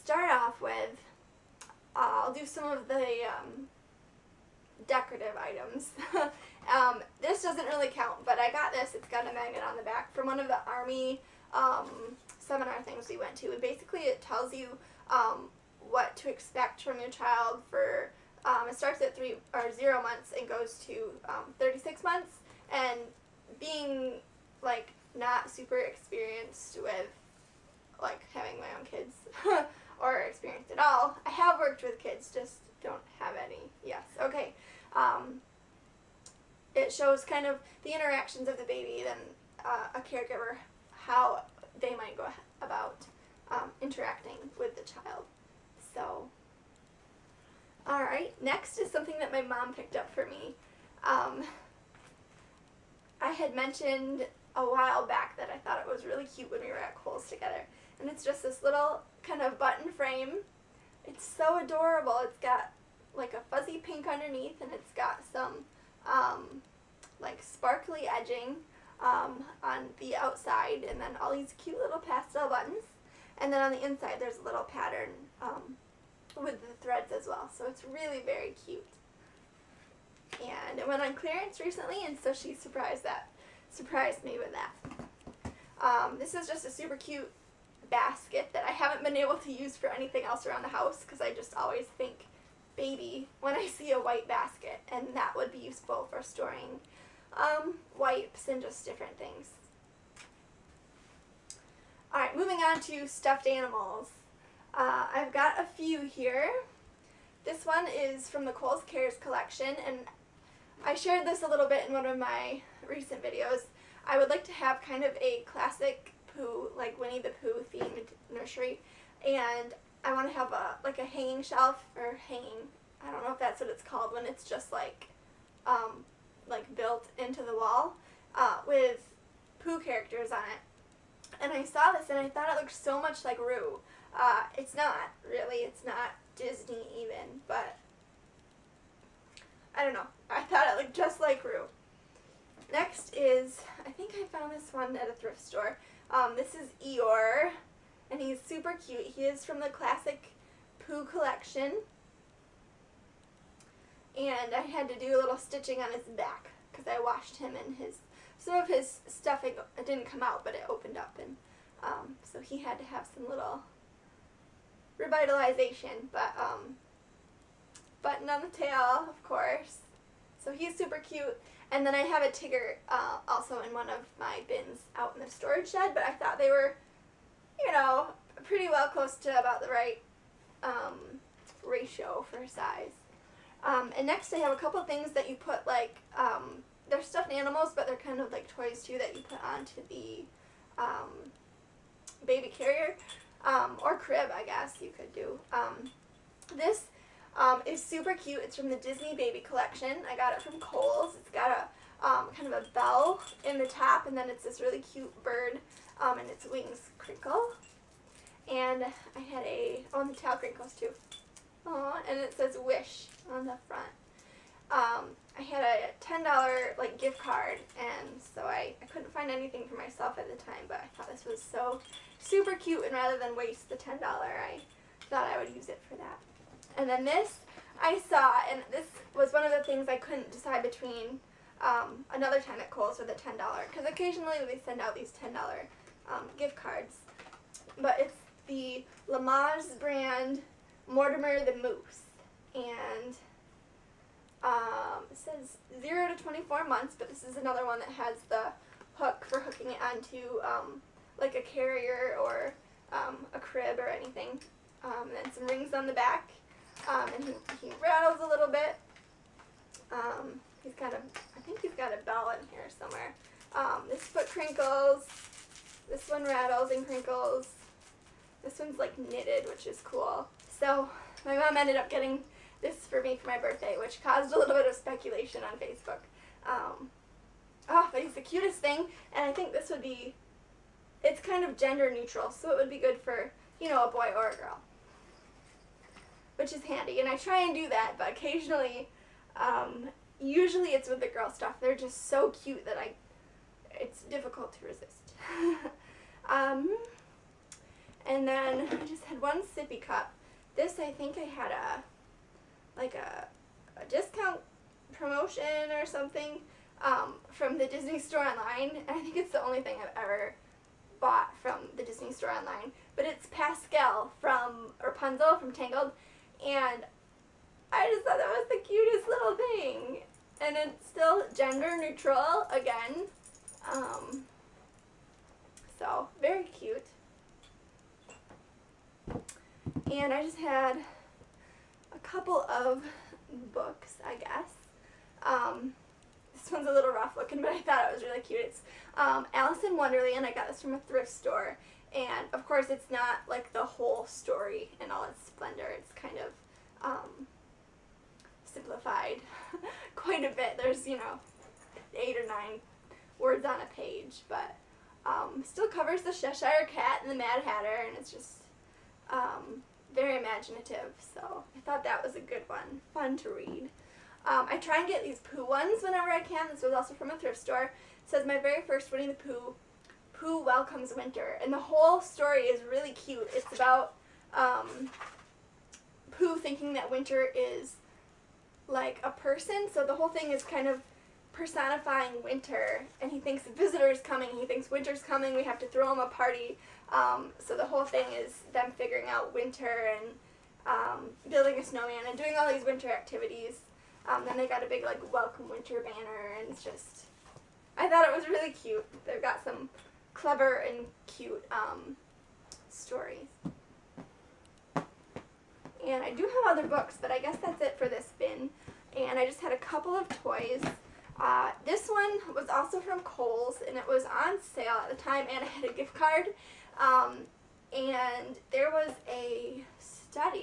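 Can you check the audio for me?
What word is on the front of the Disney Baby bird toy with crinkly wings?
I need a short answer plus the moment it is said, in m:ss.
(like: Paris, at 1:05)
Wish, at 3:32.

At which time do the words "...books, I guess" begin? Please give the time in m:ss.
5:33.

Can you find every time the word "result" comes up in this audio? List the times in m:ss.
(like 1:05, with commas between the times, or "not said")
not said.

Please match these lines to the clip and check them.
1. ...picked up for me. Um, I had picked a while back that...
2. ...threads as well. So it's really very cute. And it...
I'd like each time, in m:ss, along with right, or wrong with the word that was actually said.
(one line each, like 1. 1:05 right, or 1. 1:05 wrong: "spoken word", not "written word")
1. 0:49 wrong: "mentioned", not "picked"
2. 1:16 right.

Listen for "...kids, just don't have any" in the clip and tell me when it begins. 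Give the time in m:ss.
0:31.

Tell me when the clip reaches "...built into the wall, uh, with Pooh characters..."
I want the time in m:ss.
2:06.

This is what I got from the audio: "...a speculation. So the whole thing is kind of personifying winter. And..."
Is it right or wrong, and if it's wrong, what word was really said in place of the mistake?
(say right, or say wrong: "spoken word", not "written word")
wrong: "person", not "speculation".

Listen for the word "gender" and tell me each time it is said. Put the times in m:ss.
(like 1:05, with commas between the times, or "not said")
4:41, 5:21.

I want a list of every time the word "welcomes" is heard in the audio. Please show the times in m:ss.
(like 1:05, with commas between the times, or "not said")
6:10, 6:35.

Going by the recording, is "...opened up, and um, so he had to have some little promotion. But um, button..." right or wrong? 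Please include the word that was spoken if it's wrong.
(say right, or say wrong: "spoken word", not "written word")
wrong: "revitalization", not "promotion".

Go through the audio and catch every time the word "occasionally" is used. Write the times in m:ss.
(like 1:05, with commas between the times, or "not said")
3:53, 4:48.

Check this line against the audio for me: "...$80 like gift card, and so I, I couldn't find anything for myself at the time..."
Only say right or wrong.
wrong.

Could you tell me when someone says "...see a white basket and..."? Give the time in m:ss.
1:33.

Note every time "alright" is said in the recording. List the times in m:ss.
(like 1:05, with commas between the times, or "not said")
0:47, 1:42.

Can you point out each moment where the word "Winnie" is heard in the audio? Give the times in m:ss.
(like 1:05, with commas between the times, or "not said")
1:56, 6:08.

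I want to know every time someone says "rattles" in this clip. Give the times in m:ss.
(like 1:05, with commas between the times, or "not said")
4:17, 4:26.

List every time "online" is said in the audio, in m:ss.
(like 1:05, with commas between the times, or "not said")
5:08, 5:12.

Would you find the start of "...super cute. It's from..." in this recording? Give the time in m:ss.
3:17.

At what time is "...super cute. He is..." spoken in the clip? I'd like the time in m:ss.
2:28.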